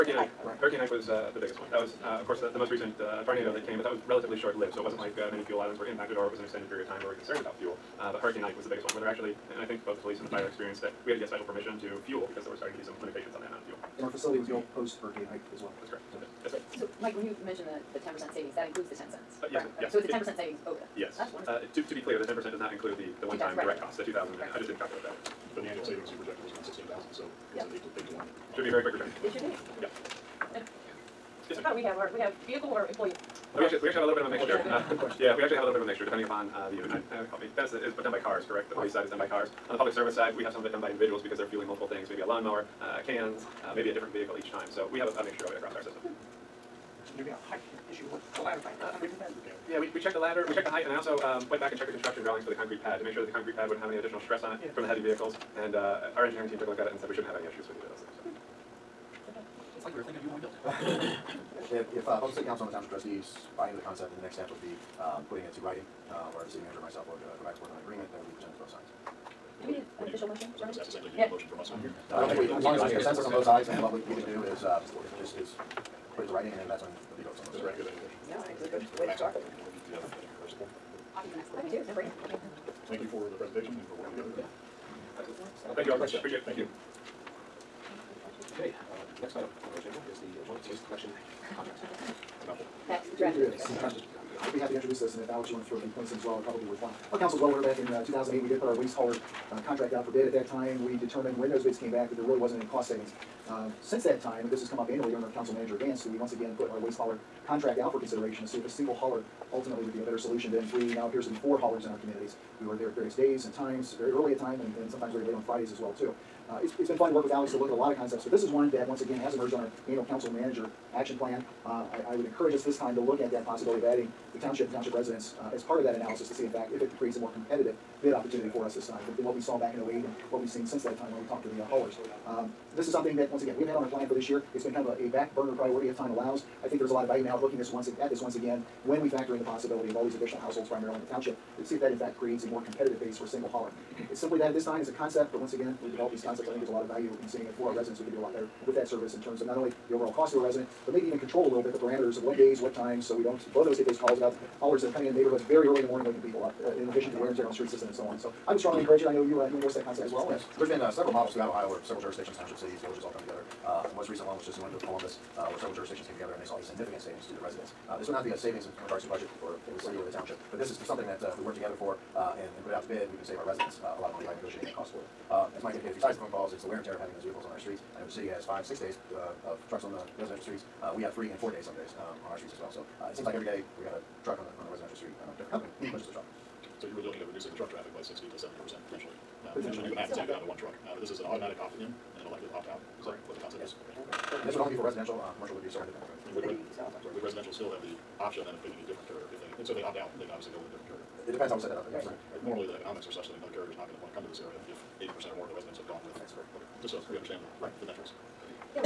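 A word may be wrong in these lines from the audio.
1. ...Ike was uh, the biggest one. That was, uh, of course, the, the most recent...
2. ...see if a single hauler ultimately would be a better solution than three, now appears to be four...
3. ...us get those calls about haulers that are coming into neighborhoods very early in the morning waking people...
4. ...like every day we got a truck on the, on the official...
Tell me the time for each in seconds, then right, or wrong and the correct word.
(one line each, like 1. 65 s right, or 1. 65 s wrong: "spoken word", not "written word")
1. 0 s right
2. 108 s right
3. 153 s right
4. 183 s wrong: "residential", not "official".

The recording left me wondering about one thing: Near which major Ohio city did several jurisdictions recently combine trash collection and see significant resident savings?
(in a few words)
Columbus.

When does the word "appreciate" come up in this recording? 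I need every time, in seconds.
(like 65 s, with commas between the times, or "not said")
85 s.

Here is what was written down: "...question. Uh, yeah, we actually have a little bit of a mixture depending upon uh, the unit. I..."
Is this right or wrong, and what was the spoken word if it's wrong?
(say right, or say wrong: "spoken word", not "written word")
right.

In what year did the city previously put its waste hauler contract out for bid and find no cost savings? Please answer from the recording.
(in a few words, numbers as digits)
2008.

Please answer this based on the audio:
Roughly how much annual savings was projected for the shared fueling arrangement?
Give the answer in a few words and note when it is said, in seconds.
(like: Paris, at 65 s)
16,000, at 26 s.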